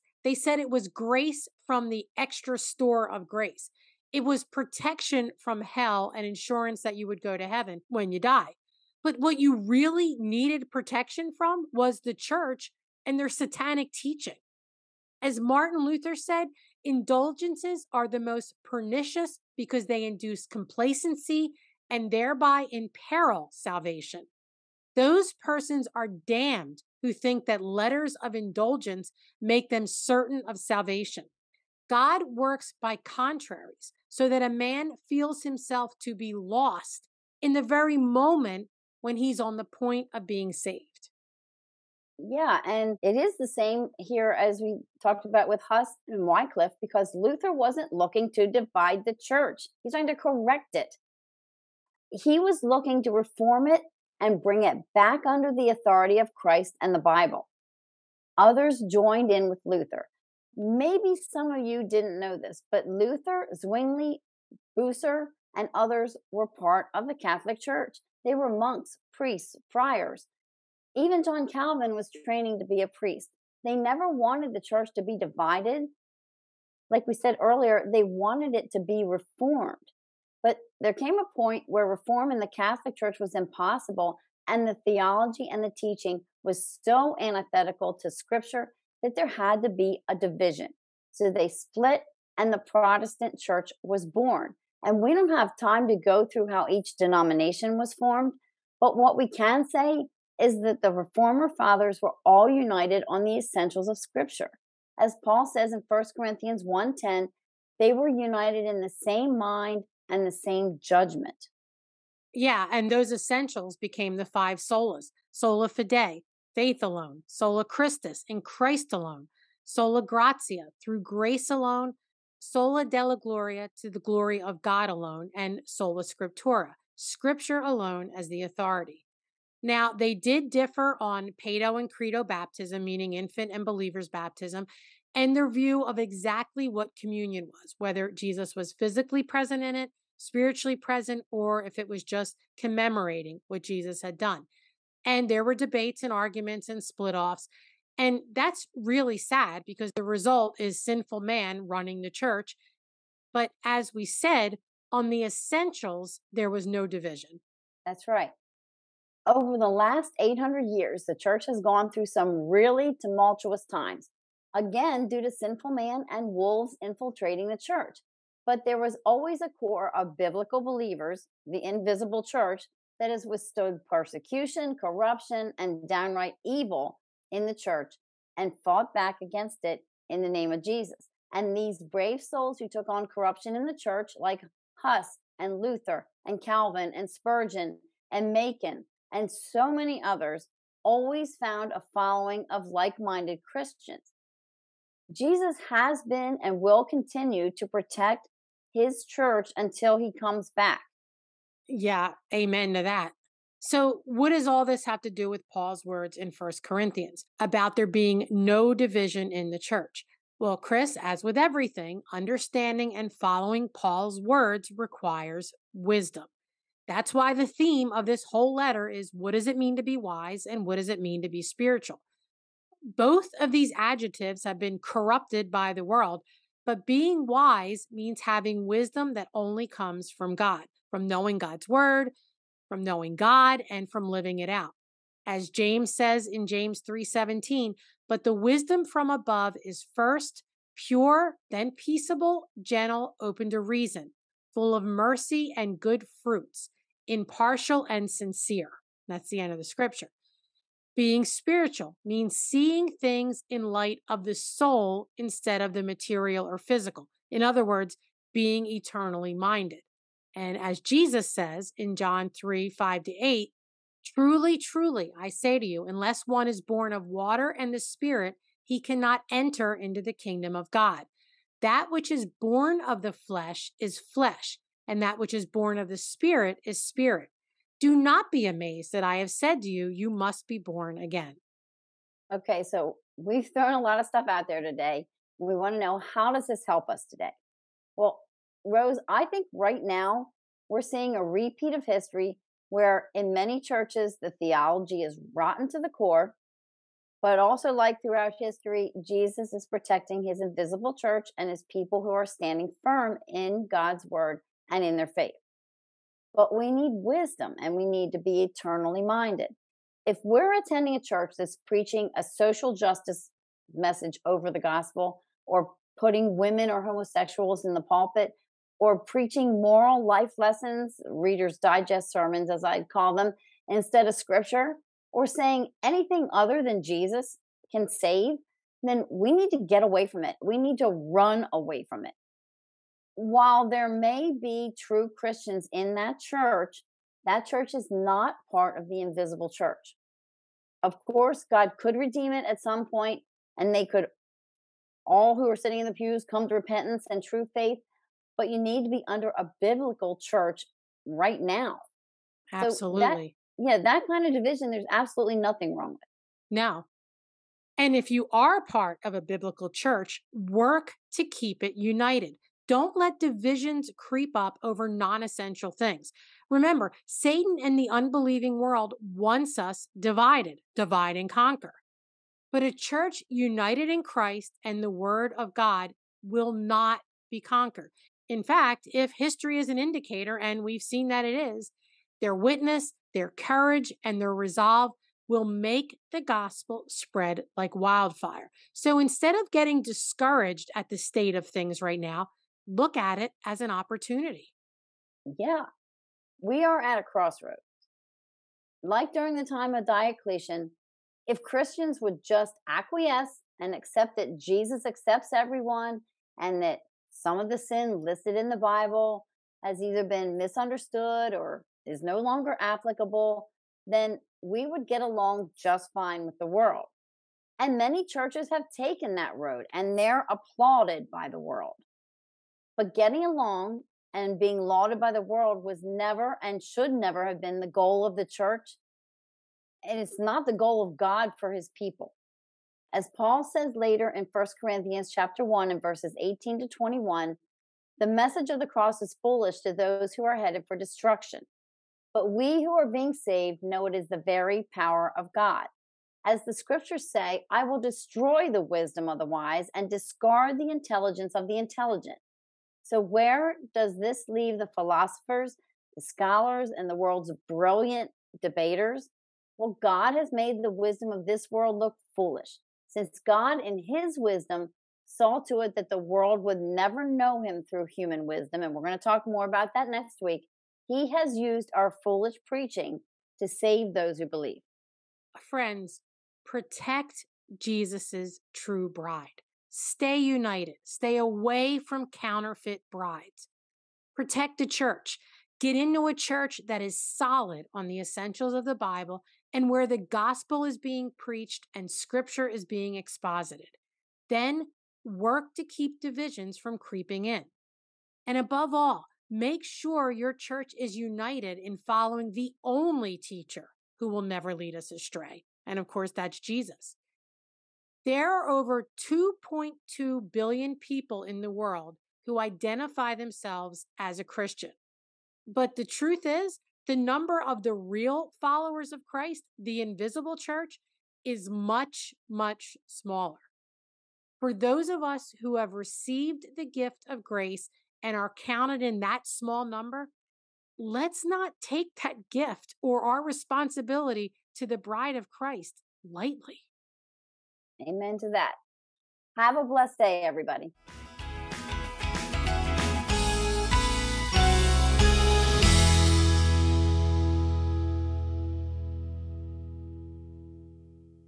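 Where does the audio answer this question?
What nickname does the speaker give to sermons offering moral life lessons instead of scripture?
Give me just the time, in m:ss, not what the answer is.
5:21.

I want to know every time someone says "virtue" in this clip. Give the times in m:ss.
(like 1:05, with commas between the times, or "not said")
not said.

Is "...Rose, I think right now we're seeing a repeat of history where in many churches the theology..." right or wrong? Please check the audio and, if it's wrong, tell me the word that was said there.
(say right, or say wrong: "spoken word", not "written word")
right.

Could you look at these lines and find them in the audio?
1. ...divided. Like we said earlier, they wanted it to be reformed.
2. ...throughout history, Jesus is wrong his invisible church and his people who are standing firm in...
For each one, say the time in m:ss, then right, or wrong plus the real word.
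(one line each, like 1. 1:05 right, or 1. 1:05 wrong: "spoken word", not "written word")
1. 1:15 right
2. 4:58 wrong: "protecting", not "wrong".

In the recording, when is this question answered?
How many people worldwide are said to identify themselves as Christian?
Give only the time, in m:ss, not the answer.
8:28.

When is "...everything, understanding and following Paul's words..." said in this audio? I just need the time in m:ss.
3:31.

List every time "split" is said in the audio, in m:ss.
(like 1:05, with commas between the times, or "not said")
1:31, 2:26.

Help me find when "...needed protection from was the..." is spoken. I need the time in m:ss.
0:10.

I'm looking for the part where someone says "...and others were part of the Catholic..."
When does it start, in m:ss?
1:05.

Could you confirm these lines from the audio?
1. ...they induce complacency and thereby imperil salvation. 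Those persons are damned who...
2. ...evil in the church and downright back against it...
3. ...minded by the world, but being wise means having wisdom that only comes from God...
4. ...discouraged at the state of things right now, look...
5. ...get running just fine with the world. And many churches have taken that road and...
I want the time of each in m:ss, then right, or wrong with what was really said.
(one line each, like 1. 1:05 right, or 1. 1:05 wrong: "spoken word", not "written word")
1. 0:19 right
2. 2:56 wrong: "fought", not "downright"
3. 3:44 wrong: "corrupted", not "minded"
4. 6:29 right
5. 6:54 wrong: "along", not "running".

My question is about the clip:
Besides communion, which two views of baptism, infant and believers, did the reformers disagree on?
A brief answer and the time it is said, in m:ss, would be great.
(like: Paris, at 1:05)
pedo and credo baptism, at 2:11.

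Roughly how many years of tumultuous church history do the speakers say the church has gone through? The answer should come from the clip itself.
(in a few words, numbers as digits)
800.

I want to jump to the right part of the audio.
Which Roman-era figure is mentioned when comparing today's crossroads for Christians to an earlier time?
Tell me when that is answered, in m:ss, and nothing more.
6:39.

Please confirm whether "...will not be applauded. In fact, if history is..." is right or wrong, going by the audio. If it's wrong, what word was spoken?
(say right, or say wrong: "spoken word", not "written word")
wrong: "conquered", not "applauded".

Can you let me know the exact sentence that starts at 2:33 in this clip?
But as we said, on the essentials, there was no division.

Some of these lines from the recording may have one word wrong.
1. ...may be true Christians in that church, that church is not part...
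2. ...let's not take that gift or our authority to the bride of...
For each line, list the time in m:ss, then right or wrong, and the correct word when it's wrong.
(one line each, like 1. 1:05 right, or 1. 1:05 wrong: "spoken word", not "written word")
1. 5:33 right
2. 8:50 wrong: "responsibility", not "authority".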